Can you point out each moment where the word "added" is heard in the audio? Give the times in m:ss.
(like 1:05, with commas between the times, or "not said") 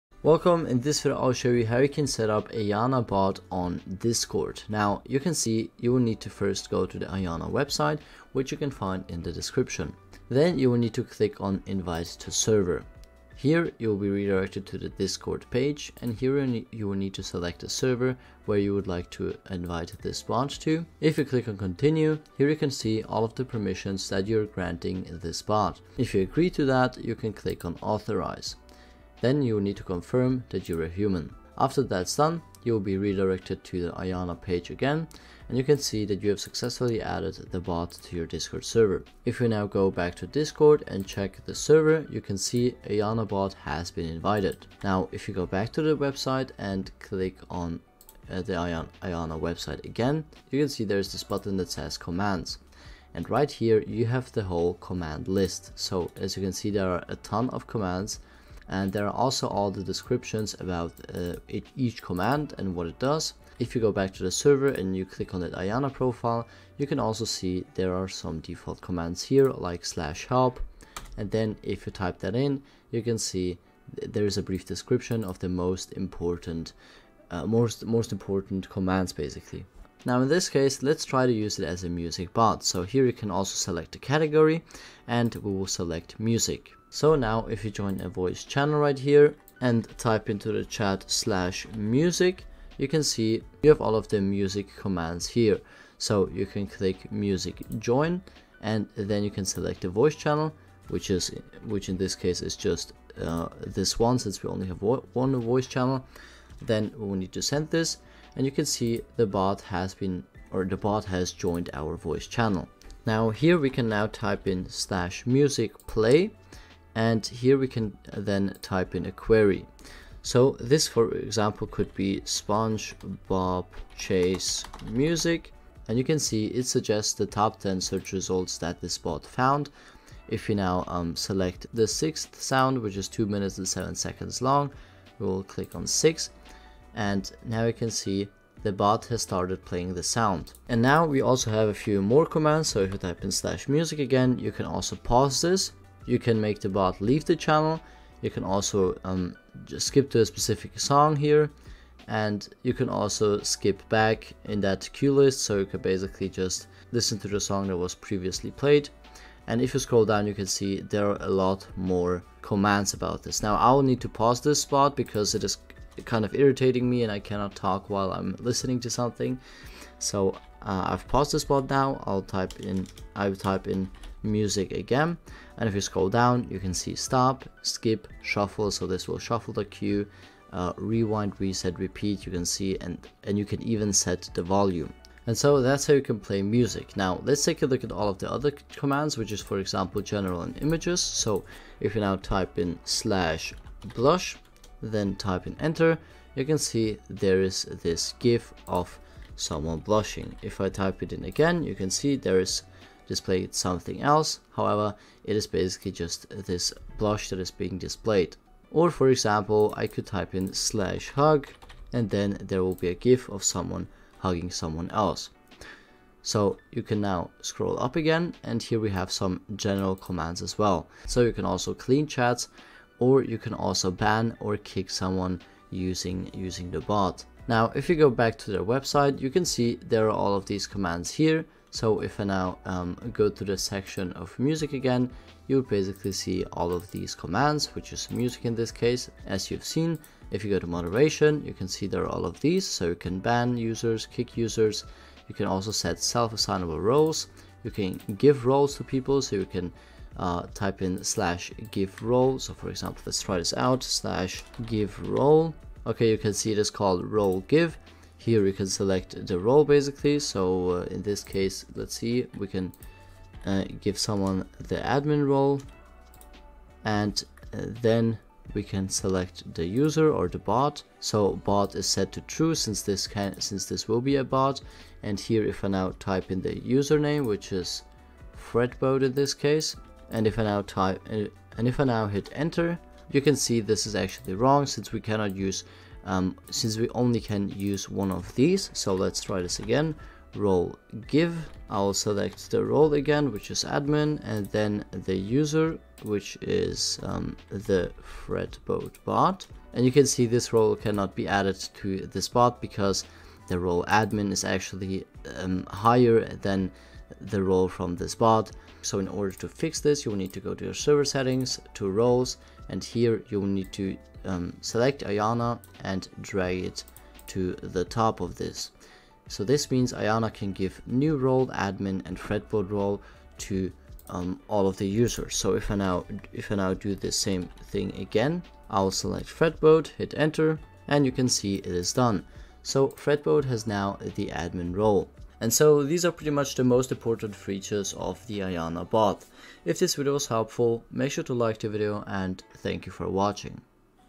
0:37, 5:01.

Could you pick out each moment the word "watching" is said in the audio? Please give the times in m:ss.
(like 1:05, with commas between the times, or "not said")
5:43.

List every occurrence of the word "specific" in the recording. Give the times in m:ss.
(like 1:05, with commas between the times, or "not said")
2:30.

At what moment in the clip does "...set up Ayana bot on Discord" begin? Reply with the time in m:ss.
0:02.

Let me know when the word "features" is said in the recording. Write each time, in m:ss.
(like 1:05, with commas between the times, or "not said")
5:37.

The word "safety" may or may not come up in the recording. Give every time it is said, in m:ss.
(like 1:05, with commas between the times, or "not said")
not said.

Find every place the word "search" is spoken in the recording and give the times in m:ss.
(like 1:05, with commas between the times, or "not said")
2:07.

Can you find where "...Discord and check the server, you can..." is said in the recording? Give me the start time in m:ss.
0:40.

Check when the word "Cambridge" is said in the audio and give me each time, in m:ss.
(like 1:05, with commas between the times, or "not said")
not said.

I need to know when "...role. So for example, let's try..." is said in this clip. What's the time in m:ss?
4:12.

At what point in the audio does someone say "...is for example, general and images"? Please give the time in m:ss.
3:09.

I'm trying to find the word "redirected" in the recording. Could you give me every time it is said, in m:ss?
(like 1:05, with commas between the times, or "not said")
0:14, 0:32.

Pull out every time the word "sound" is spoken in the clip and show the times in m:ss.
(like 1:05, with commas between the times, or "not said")
2:12, 2:20.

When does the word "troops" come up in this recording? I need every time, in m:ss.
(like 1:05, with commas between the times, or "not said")
not said.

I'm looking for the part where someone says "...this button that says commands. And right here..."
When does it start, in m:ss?
0:51.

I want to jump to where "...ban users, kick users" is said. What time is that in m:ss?
4:03.